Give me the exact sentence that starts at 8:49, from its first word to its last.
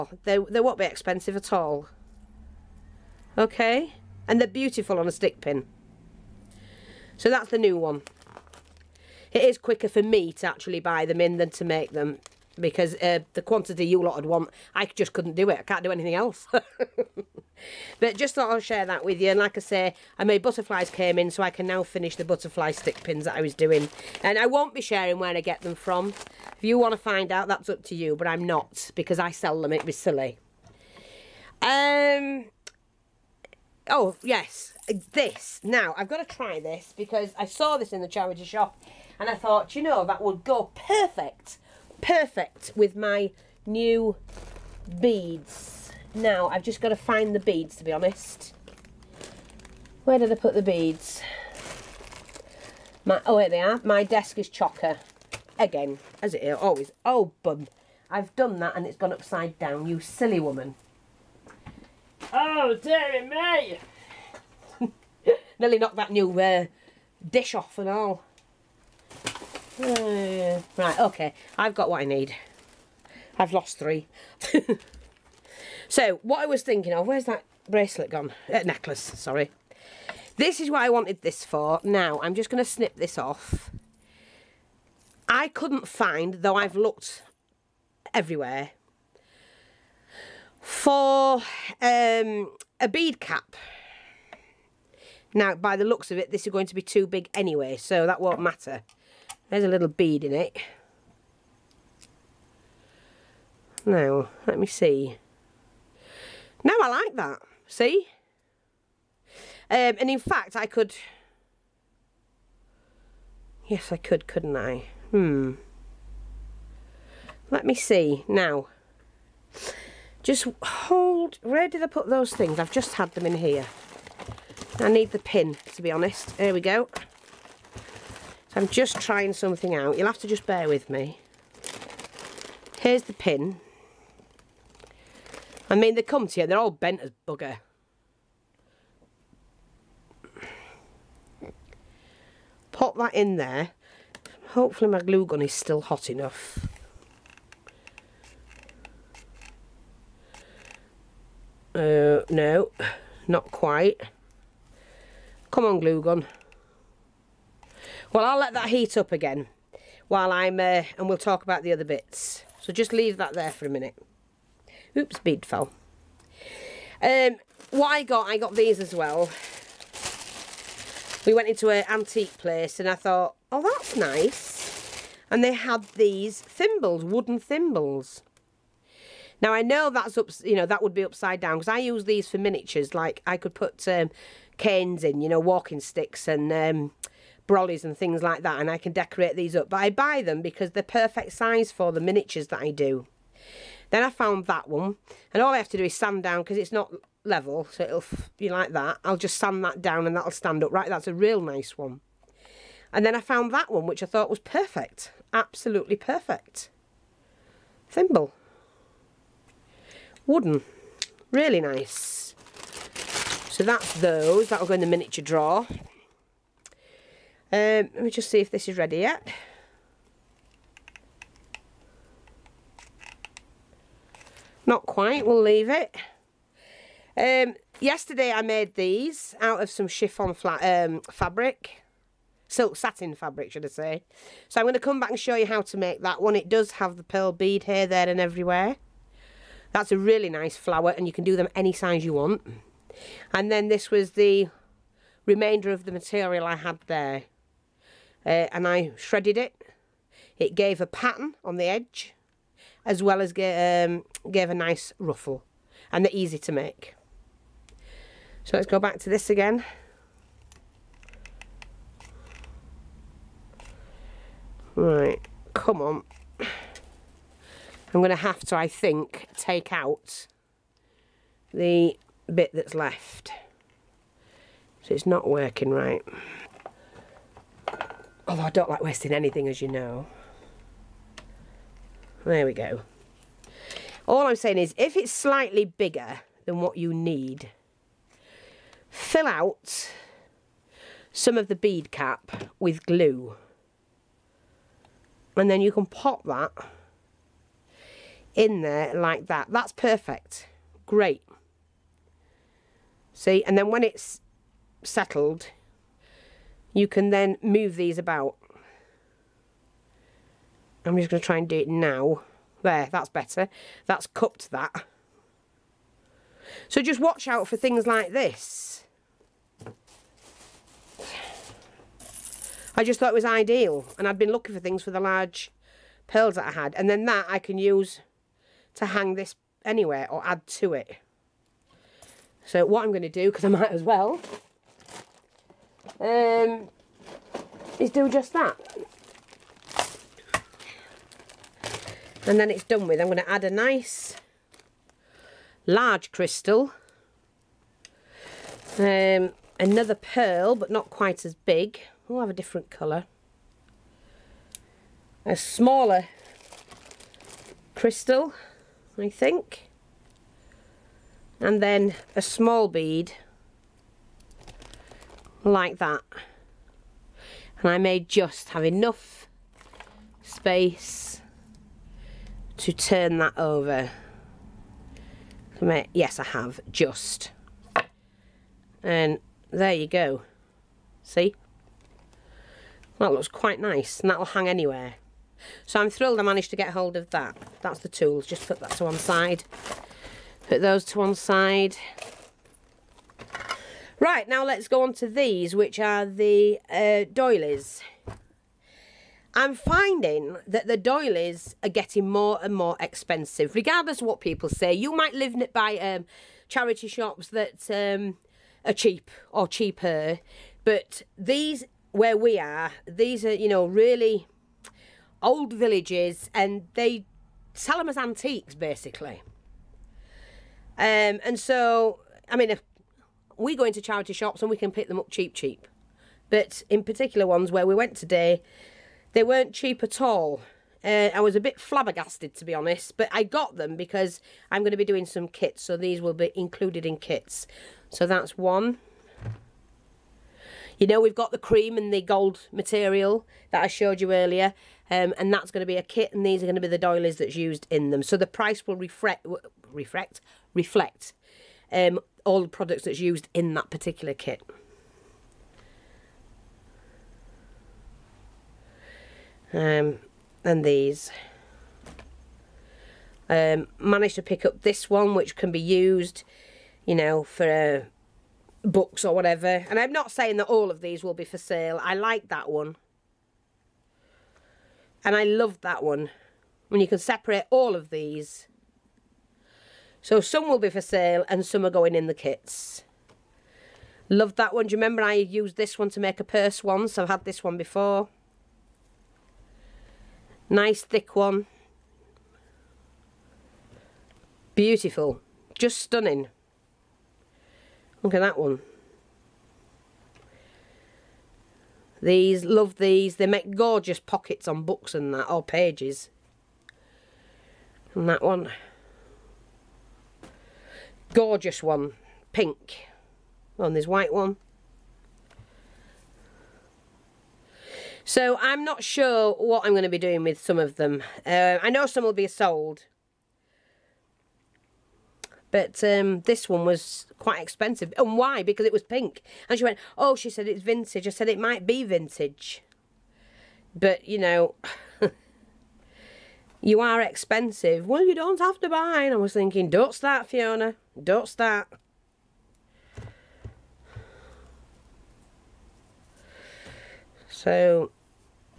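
And she went, oh, she said it's vintage.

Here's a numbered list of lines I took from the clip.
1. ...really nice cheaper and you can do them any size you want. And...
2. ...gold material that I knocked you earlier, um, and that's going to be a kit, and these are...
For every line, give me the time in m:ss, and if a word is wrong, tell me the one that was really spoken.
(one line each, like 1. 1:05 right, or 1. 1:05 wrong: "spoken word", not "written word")
1. 3:59 wrong: "flower", not "cheaper"
2. 7:22 wrong: "showed", not "knocked".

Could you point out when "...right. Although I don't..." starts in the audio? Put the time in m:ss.
4:35.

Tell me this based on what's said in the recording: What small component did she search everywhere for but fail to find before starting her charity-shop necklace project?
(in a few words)
A bead cap.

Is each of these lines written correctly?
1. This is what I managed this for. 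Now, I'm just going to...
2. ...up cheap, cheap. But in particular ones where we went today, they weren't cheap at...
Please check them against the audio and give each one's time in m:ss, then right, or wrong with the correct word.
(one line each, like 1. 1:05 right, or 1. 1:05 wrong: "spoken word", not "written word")
1. 1:20 wrong: "wanted", not "managed"
2. 7:04 right.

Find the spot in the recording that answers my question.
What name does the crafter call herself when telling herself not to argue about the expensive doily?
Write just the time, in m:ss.
9:00.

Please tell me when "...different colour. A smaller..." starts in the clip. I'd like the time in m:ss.
5:52.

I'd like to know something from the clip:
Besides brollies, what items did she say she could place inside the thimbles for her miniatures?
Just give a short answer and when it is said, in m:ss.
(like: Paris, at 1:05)
Walking sticks, at 3:05.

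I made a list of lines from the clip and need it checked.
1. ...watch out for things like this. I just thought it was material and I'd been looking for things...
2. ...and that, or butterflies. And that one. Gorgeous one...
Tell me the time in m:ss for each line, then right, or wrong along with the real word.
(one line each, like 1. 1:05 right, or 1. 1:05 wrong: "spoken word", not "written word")
1. 5:17 wrong: "ideal", not "material"
2. 8:24 wrong: "pages", not "butterflies".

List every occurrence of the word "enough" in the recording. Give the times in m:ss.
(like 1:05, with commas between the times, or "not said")
2:26, 6:08.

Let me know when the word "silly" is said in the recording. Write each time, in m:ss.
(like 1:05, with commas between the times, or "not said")
0:29, 1:00.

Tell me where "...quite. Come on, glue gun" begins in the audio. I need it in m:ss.
2:33.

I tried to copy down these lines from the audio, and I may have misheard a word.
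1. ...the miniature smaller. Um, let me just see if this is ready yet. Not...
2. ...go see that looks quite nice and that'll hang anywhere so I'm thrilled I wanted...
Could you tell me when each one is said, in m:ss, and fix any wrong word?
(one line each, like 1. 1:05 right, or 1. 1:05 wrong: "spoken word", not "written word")
1. 3:34 wrong: "drawer", not "smaller"
2. 6:19 wrong: "managed", not "wanted".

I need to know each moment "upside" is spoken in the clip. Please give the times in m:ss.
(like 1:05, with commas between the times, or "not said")
0:59, 3:01.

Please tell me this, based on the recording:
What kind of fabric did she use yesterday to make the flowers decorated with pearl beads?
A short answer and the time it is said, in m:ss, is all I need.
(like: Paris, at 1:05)
Silk satin, at 3:52.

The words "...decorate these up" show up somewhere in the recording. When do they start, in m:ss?
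3:08.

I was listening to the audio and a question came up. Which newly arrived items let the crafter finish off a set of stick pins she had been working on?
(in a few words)
Butterflies.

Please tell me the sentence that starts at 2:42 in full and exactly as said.
So just leave that there for a minute.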